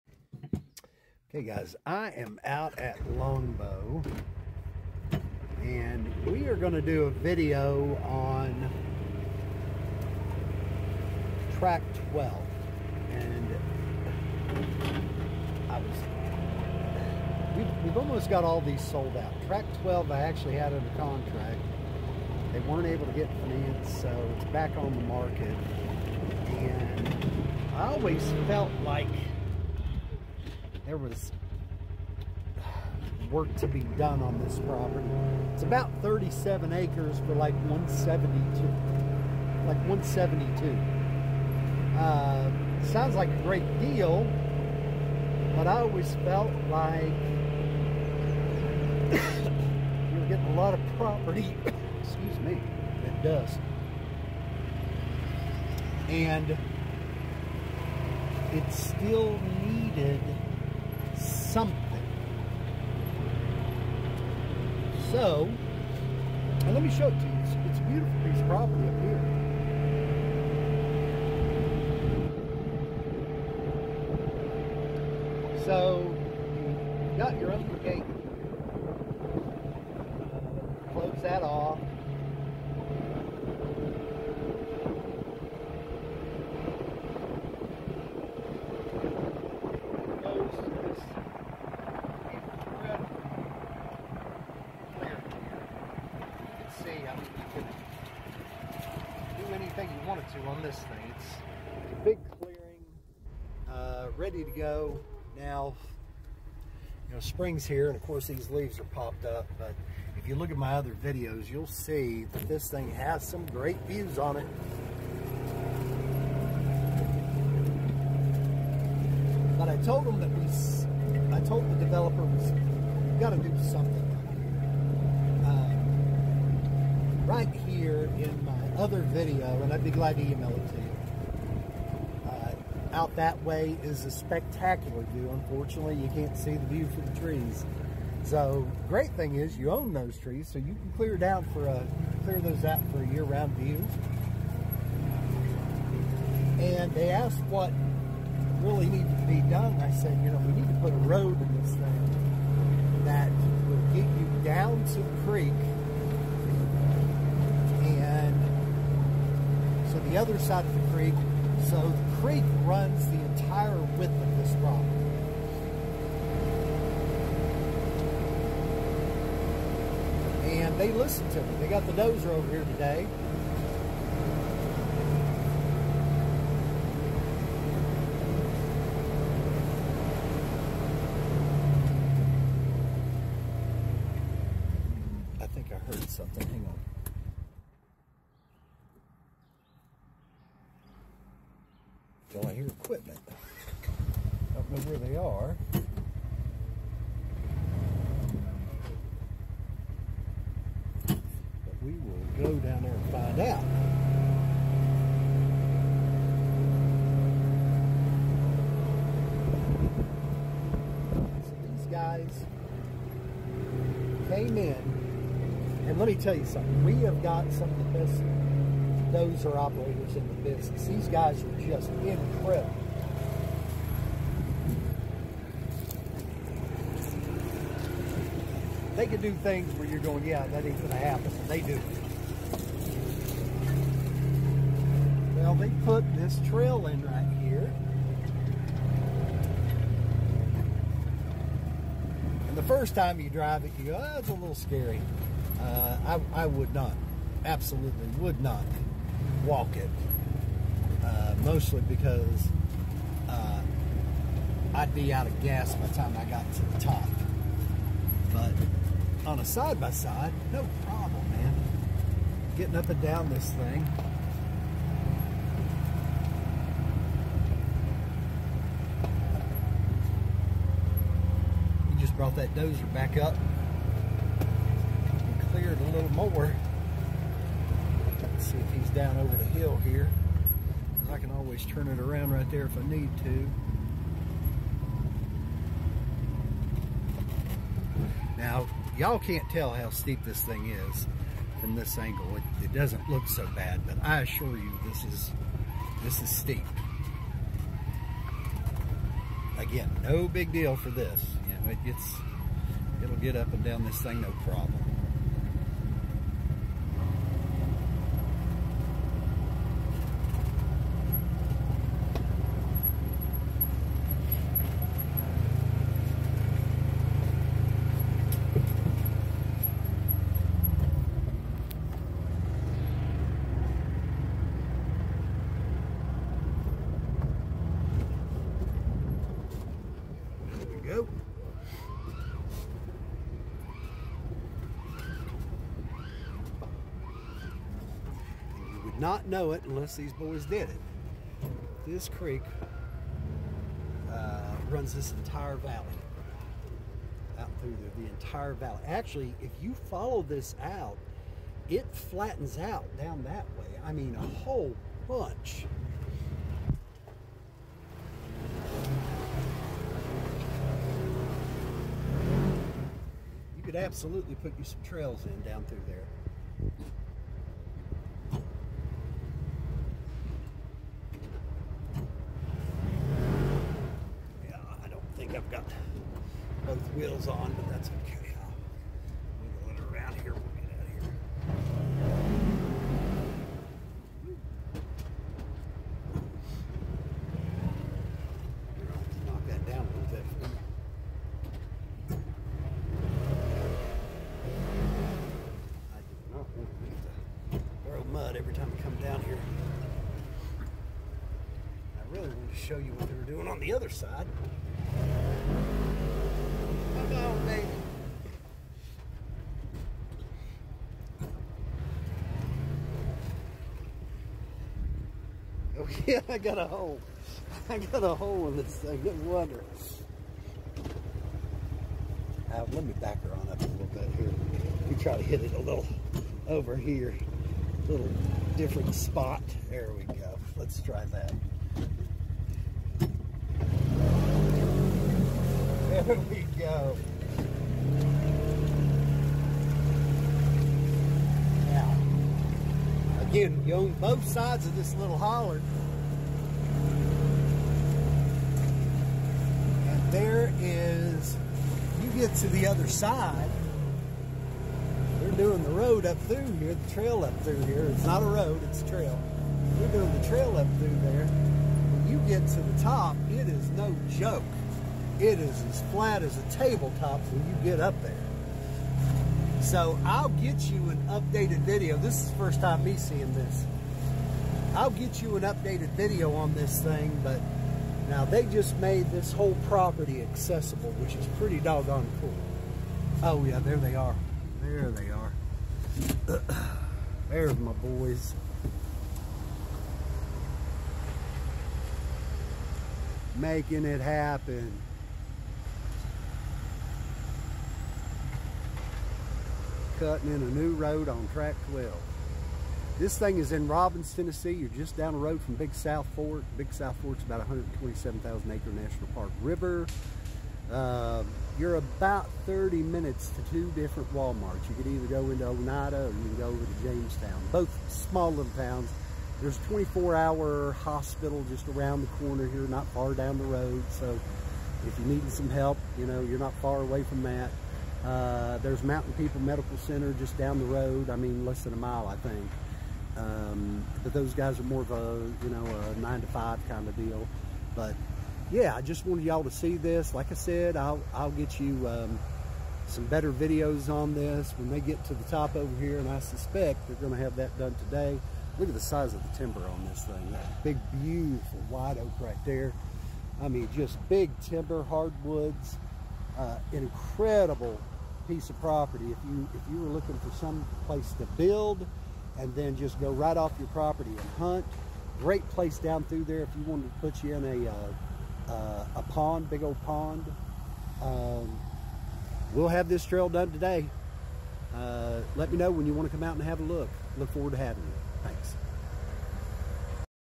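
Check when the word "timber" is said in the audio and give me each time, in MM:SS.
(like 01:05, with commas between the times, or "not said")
09:09, 09:14.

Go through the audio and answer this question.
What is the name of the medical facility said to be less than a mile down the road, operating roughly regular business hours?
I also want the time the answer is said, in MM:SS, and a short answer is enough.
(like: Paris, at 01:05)
Mountain People Medical Center, at 08:48.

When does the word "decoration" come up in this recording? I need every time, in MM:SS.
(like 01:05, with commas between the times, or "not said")
not said.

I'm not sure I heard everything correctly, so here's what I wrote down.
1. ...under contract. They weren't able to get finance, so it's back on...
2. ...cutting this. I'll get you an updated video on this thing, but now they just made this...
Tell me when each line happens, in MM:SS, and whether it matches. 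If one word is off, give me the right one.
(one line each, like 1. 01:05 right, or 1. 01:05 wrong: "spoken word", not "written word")
1. 00:20 right
2. 07:52 wrong: "seeing", not "cutting".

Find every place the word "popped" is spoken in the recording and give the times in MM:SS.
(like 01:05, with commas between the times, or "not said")
01:48.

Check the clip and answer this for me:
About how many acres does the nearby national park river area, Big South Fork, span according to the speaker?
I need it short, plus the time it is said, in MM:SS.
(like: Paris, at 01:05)
127,000, at 08:27.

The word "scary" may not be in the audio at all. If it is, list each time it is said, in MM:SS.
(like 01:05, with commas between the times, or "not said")
04:04.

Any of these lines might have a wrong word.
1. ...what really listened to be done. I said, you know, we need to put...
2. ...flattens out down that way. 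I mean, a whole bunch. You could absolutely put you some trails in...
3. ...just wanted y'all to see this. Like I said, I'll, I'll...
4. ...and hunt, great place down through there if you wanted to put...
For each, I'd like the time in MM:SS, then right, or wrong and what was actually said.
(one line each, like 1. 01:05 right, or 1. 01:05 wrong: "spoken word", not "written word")
1. 02:27 wrong: "needed", not "listened"
2. 05:51 right
3. 08:58 right
4. 09:24 right.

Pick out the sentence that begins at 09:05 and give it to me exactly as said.
And I suspect they're going to have that done today.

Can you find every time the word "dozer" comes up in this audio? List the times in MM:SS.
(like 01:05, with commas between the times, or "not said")
02:51, 04:32.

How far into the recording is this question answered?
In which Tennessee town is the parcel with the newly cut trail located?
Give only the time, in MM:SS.
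08:23.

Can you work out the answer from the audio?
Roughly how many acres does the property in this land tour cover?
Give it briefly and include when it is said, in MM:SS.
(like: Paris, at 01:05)
37, at 00:36.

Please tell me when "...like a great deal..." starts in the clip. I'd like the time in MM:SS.
00:43.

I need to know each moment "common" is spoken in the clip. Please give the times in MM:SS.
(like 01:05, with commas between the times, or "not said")
not said.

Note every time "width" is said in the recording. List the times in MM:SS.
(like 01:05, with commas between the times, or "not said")
02:43.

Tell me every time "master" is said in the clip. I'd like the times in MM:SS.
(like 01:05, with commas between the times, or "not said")
not said.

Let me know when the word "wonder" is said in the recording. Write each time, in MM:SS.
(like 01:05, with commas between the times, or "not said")
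06:59.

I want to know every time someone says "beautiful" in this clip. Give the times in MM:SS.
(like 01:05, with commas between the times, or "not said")
01:07, 09:11.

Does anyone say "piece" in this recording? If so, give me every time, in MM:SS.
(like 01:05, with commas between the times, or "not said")
01:08, 09:18.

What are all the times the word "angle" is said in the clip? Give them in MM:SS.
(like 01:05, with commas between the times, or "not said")
04:51.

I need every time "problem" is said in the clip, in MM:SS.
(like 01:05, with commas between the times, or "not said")
04:20, 05:04.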